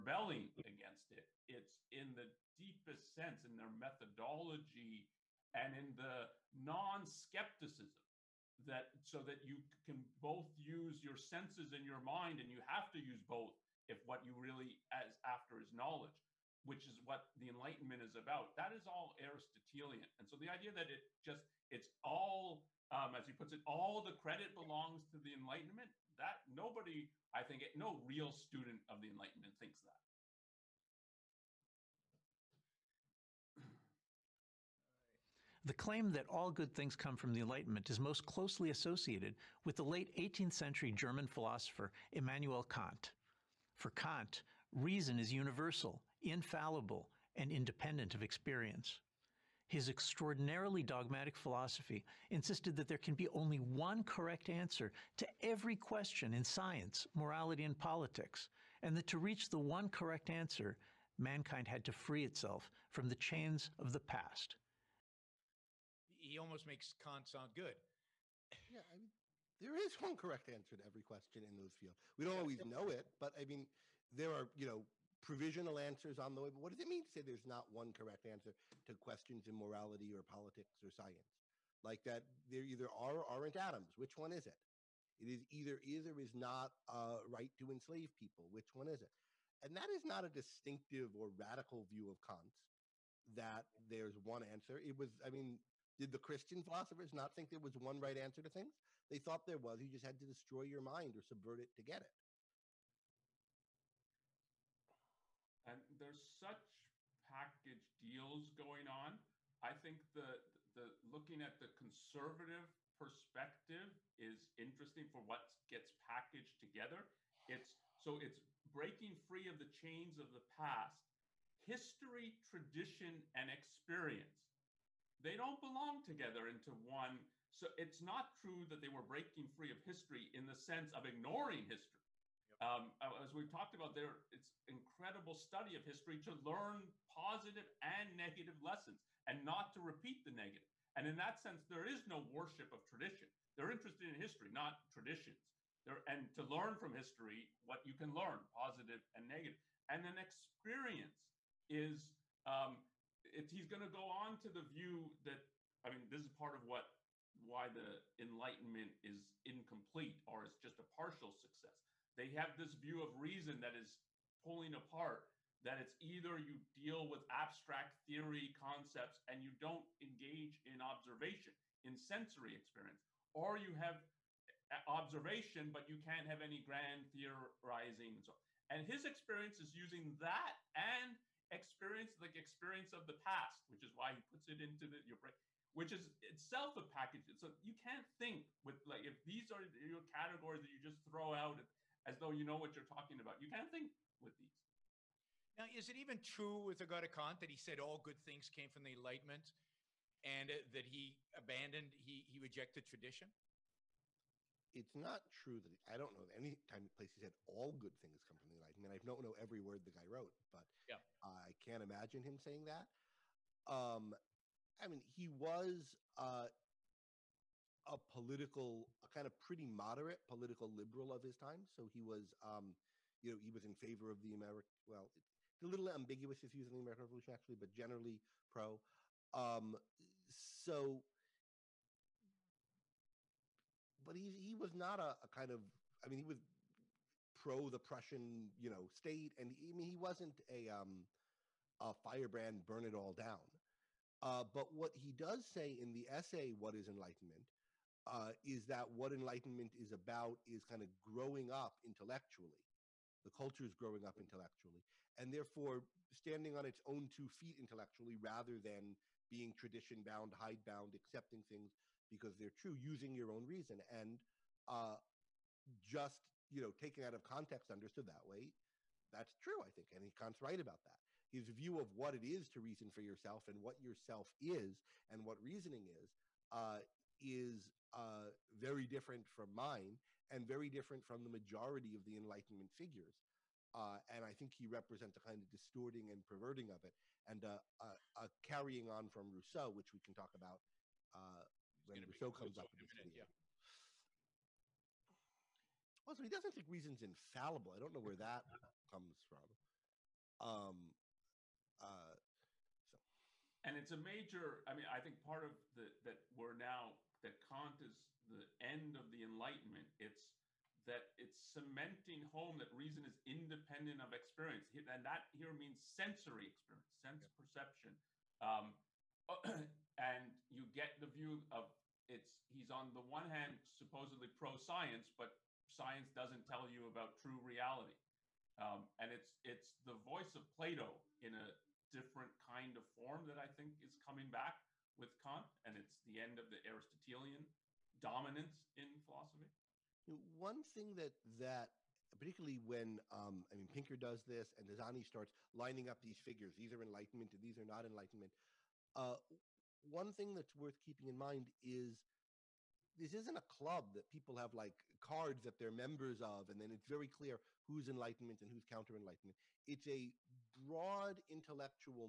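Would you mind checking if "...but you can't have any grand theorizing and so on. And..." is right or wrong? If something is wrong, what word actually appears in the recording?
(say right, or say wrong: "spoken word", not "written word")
right.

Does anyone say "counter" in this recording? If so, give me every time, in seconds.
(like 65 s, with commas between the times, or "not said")
358 s.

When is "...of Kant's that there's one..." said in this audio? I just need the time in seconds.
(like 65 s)
92 s.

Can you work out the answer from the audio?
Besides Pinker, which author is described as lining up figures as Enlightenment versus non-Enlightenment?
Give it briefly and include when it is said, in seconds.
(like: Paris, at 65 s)
Hazony, at 344 s.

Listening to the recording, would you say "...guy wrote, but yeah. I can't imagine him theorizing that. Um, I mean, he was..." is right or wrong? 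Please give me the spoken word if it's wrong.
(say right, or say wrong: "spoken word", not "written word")
wrong: "saying", not "theorizing".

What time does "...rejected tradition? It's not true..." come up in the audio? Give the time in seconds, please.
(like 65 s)
202 s.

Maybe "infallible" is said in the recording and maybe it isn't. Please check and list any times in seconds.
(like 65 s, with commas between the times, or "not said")
46 s, 297 s.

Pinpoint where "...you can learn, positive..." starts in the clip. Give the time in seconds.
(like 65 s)
147 s.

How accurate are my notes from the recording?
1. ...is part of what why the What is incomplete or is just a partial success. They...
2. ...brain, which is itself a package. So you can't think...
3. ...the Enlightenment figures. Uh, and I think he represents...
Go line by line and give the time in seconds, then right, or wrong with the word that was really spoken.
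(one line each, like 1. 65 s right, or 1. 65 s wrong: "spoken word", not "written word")
1. 156 s wrong: "Enlightenment", not "What"
2. 185 s right
3. 282 s right.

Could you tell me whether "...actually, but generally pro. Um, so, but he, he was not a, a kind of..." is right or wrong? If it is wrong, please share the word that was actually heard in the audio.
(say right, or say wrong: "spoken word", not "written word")
right.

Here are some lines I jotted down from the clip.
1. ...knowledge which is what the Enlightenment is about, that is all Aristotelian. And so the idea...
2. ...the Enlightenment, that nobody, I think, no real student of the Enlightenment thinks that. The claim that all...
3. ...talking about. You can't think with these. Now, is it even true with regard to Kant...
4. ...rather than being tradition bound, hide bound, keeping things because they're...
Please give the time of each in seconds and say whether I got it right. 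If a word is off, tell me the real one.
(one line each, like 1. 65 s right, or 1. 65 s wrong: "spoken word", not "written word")
1. 15 s right
2. 25 s right
3. 192 s right
4. 258 s wrong: "accepting", not "keeping".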